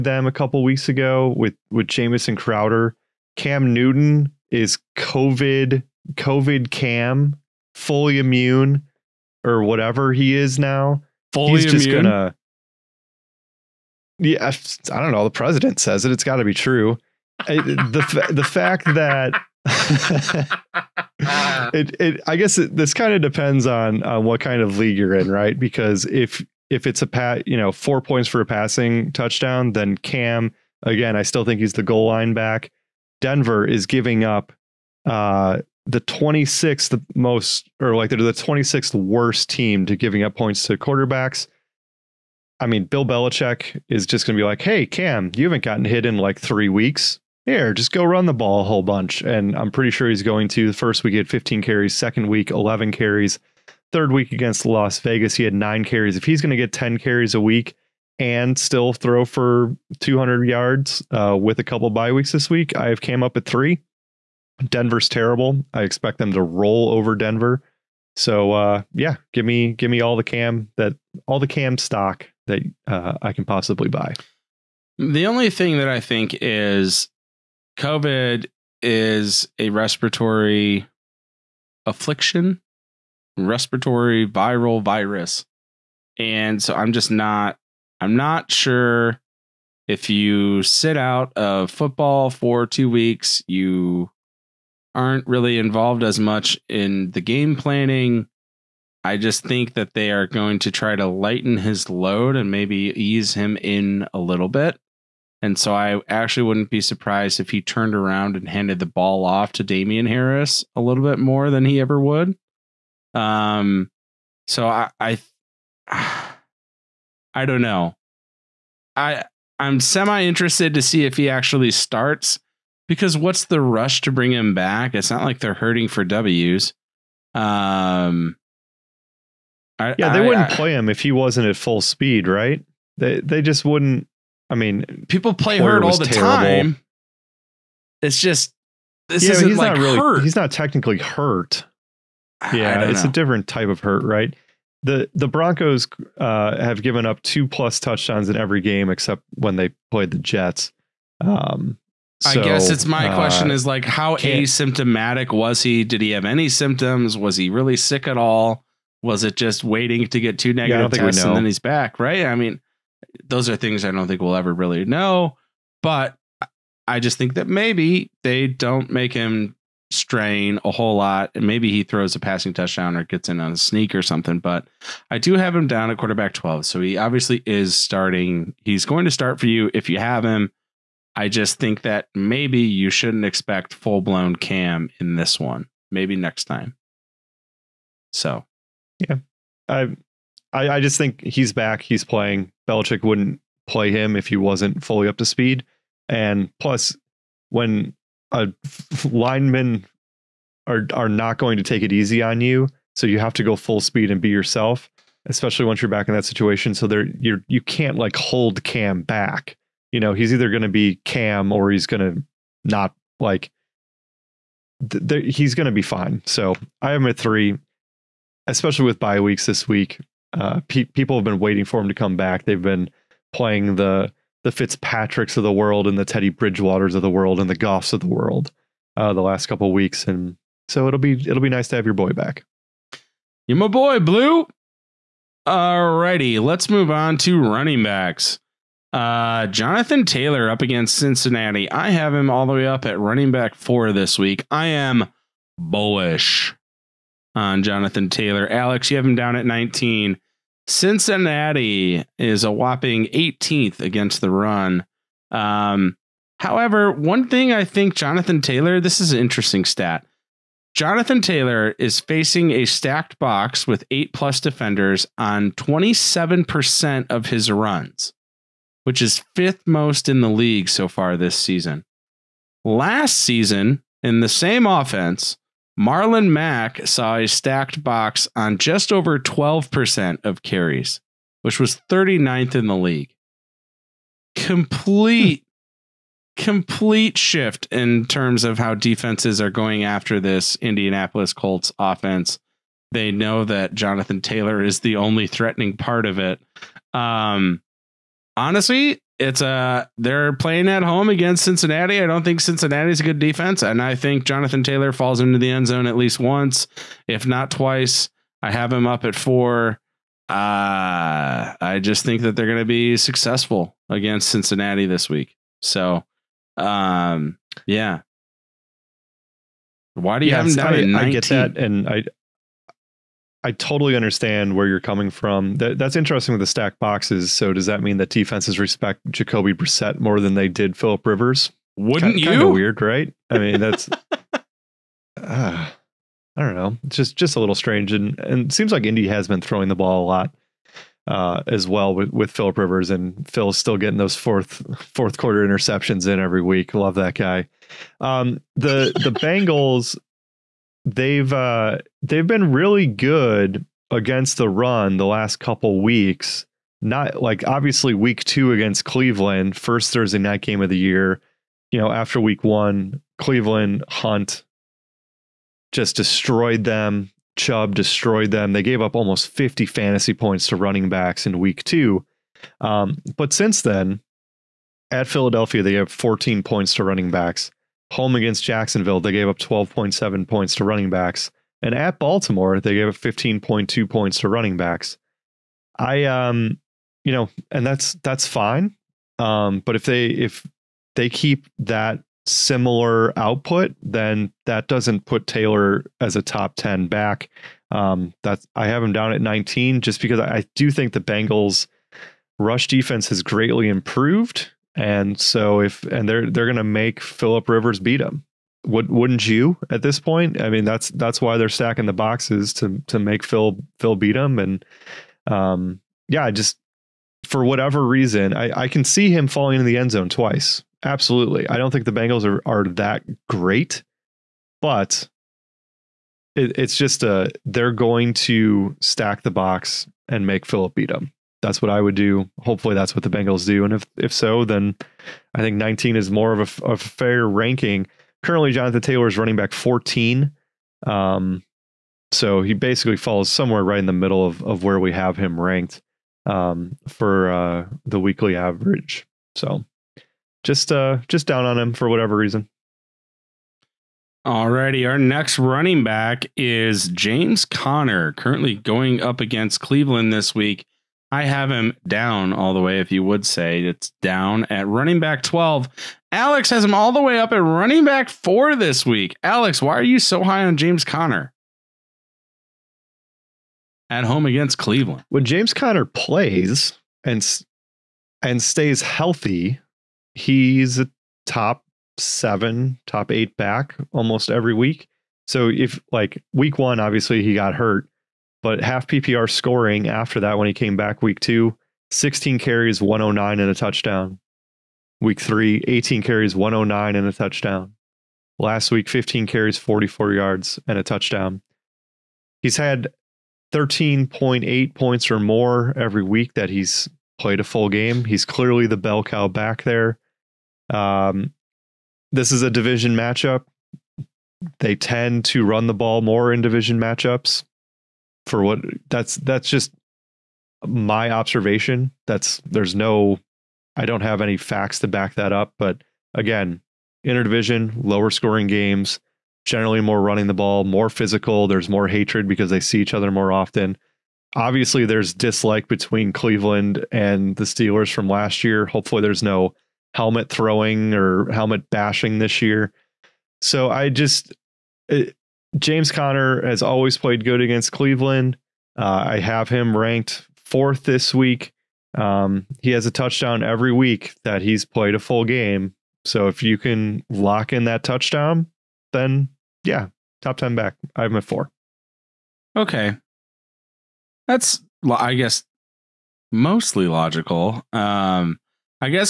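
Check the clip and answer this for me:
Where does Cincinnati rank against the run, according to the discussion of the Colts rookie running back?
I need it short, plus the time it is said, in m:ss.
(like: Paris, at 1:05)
18th, at 4:13.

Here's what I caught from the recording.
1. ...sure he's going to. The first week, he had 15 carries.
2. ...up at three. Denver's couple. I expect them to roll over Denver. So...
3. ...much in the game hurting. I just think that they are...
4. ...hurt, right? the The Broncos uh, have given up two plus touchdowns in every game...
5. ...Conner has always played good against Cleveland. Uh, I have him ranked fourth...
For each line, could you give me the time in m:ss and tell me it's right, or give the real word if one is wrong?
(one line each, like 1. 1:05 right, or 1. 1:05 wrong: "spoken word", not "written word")
1. 0:49 right
2. 1:03 wrong: "terrible", not "couple"
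3. 1:36 wrong: "planning", not "hurting"
4. 2:23 right
5. 9:05 right.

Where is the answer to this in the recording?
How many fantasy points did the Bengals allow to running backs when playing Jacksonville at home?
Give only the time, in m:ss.
6:19.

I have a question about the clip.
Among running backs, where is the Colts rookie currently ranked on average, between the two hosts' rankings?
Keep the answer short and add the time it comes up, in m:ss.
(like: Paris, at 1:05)
Running back 14, at 7:19.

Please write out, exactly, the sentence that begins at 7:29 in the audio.
So just uh, just down on him for whatever reason.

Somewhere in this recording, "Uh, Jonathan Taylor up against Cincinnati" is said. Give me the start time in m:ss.
3:58.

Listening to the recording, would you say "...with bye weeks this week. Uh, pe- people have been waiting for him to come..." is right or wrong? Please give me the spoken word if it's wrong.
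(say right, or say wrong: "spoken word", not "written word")
right.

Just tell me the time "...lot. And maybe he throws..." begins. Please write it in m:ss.
2:50.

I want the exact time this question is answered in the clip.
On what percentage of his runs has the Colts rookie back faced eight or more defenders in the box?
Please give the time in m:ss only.
4:25.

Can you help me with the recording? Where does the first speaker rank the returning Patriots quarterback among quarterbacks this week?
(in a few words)
12.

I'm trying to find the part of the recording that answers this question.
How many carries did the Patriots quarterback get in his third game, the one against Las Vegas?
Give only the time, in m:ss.
0:55.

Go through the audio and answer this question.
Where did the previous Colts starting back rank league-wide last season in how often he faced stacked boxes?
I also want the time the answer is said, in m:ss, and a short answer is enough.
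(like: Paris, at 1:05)
39th, at 4:41.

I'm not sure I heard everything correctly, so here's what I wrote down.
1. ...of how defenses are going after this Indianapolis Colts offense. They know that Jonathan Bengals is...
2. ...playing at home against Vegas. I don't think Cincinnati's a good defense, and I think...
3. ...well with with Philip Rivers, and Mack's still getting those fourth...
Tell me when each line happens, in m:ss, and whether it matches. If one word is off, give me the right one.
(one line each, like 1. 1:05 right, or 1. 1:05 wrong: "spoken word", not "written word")
1. 4:48 wrong: "Taylor", not "Bengals"
2. 5:00 wrong: "Cincinnati", not "Vegas"
3. 5:41 wrong: "Phil", not "Mack".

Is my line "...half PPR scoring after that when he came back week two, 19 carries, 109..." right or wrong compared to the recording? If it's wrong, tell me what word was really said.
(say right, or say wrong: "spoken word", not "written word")
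wrong: "16", not "19".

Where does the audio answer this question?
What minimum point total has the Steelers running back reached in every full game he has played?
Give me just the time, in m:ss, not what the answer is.
8:23.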